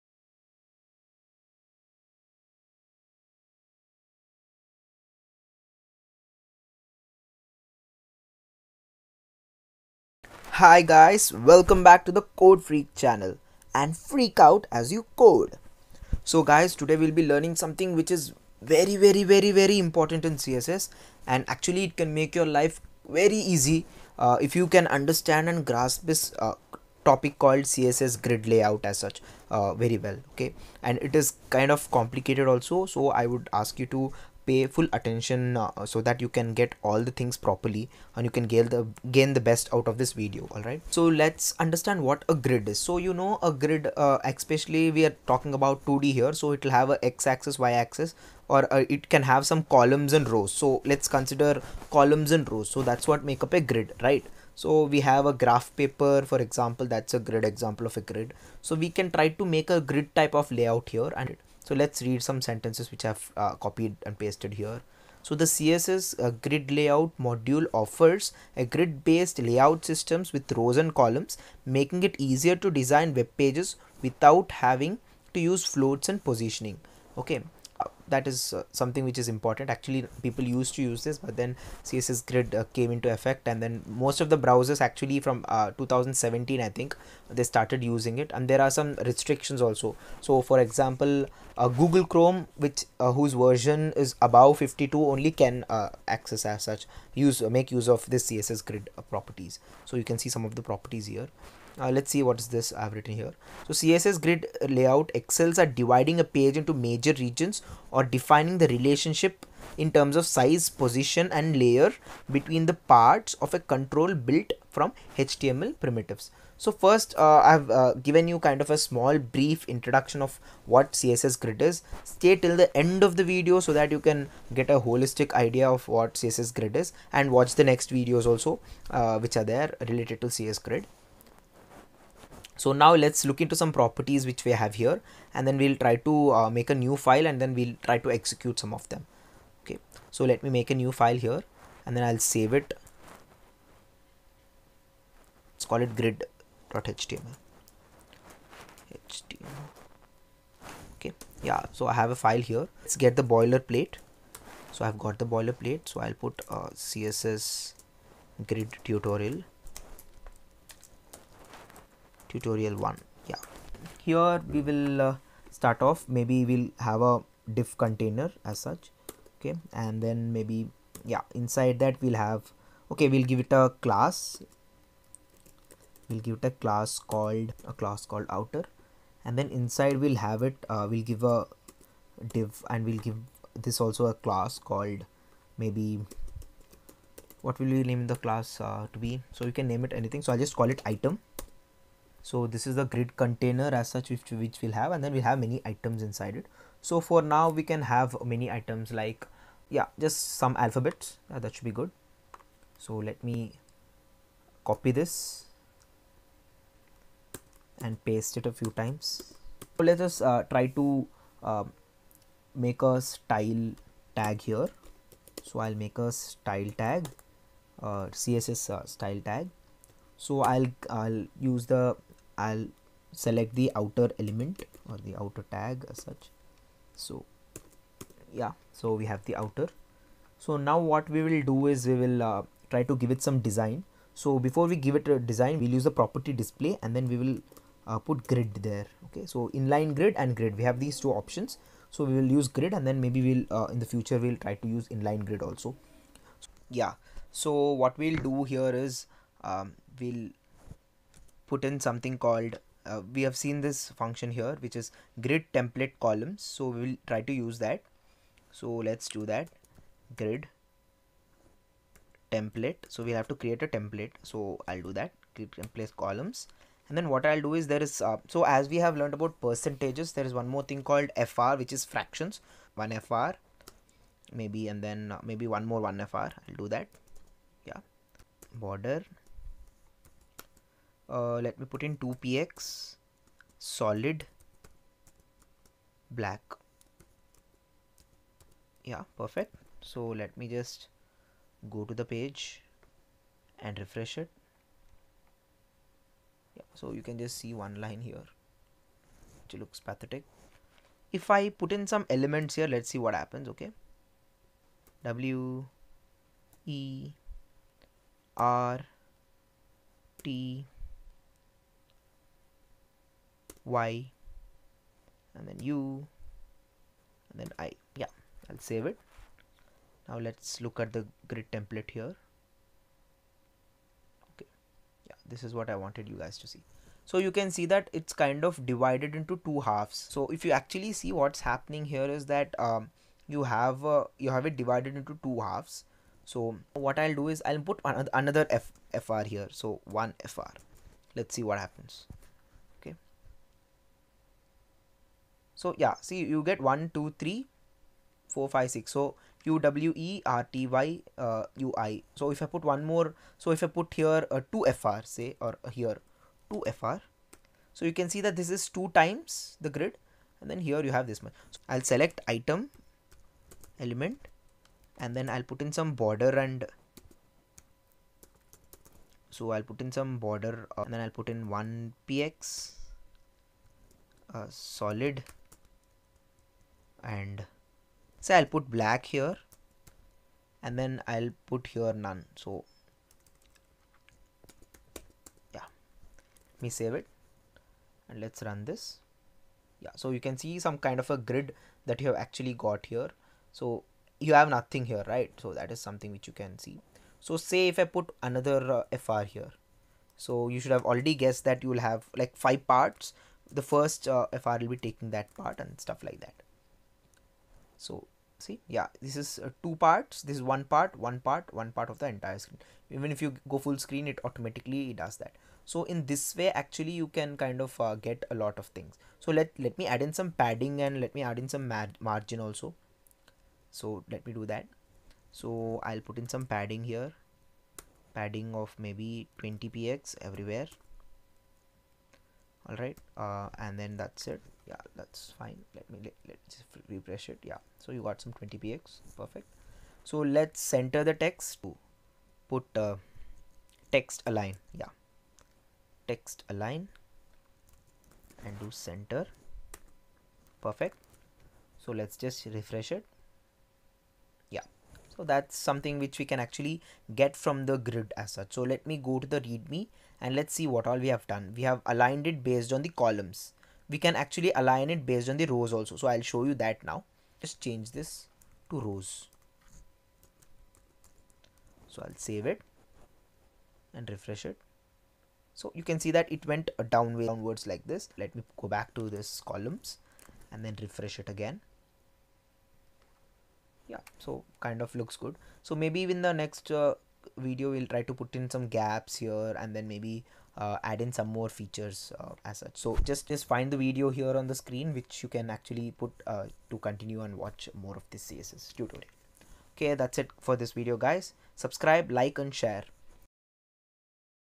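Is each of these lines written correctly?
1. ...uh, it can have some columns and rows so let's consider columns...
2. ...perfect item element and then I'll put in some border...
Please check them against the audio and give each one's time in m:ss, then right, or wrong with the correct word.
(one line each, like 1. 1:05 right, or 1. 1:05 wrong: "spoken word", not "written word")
1. 0:48 right
2. 6:01 wrong: "select", not "perfect".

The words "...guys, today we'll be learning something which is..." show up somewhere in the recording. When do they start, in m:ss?
0:16.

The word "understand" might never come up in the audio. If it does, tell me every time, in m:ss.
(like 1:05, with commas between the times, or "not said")
0:24, 0:41.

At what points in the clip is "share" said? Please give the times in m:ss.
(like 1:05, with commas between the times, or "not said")
8:22.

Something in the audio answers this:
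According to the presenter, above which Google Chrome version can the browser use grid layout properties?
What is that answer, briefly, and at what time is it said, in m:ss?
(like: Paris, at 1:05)
52, at 1:34.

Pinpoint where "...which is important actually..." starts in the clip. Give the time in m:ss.
1:19.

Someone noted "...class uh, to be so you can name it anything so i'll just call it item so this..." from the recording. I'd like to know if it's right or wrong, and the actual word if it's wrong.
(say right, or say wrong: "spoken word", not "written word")
right.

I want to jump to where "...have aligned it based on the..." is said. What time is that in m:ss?
7:41.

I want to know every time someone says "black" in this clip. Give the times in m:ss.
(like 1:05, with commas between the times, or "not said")
4:46, 6:18.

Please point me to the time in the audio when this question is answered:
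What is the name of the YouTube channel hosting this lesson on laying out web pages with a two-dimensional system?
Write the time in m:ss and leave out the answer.
0:12.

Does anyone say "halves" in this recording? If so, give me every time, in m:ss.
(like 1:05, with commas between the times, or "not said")
5:29, 5:35.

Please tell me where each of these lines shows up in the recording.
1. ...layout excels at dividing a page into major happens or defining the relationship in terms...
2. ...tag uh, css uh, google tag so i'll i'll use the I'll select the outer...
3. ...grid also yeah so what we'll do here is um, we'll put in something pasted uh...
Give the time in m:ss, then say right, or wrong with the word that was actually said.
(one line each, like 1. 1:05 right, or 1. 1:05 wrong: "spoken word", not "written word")
1. 1:44 wrong: "regions", not "happens"
2. 3:36 wrong: "style", not "google"
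3. 4:05 wrong: "called", not "pasted".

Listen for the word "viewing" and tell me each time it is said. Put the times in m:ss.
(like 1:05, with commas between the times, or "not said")
not said.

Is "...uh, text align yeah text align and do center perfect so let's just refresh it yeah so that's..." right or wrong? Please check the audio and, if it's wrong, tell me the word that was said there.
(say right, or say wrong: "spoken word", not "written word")
right.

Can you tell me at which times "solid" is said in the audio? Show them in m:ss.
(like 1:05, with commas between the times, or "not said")
4:43, 6:14.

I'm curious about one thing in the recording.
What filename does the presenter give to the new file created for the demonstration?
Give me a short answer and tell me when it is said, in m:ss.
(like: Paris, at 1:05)
grid.html, at 2:25.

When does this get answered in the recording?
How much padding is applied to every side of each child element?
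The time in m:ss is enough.
7:09.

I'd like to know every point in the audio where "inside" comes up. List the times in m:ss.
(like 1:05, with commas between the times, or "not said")
2:51, 2:59, 3:16.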